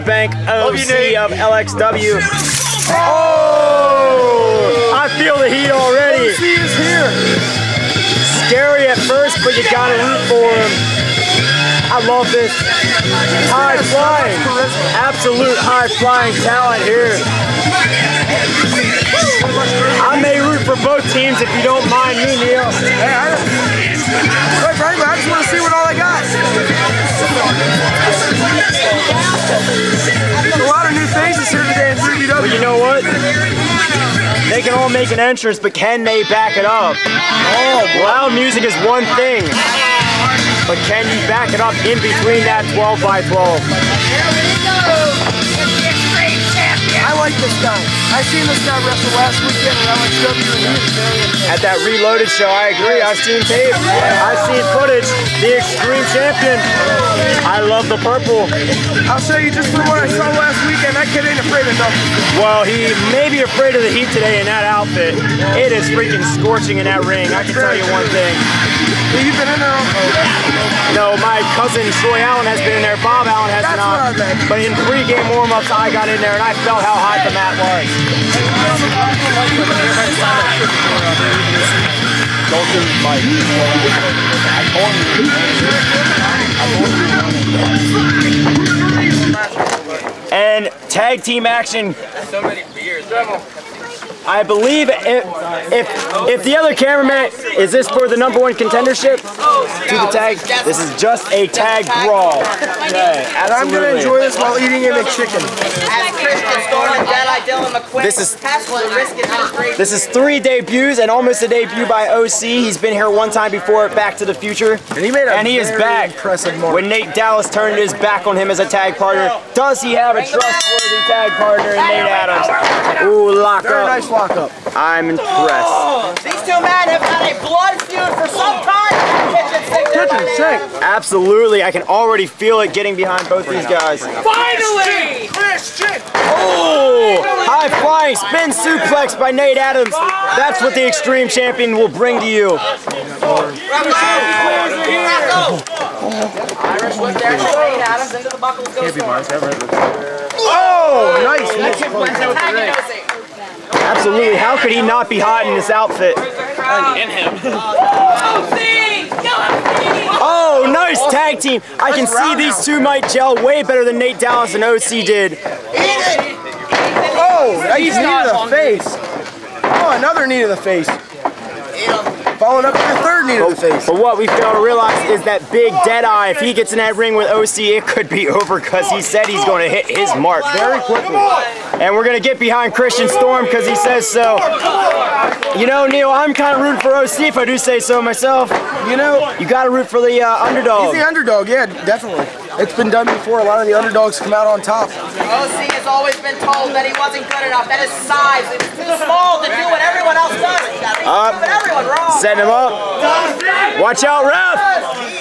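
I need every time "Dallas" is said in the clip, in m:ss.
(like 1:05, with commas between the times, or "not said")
1:57, 2:44.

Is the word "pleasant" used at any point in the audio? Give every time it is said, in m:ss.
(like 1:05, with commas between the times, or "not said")
not said.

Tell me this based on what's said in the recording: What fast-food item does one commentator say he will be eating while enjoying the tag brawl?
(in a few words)
McChicken.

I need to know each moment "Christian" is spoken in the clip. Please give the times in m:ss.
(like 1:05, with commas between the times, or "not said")
2:15, 3:02.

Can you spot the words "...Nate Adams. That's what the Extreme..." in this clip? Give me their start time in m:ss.
2:19.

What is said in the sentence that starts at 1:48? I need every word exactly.
This is, this is three debuts and almost a debut by OC.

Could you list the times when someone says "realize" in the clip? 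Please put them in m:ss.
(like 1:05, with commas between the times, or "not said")
2:54.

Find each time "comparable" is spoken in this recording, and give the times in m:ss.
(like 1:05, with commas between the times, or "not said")
not said.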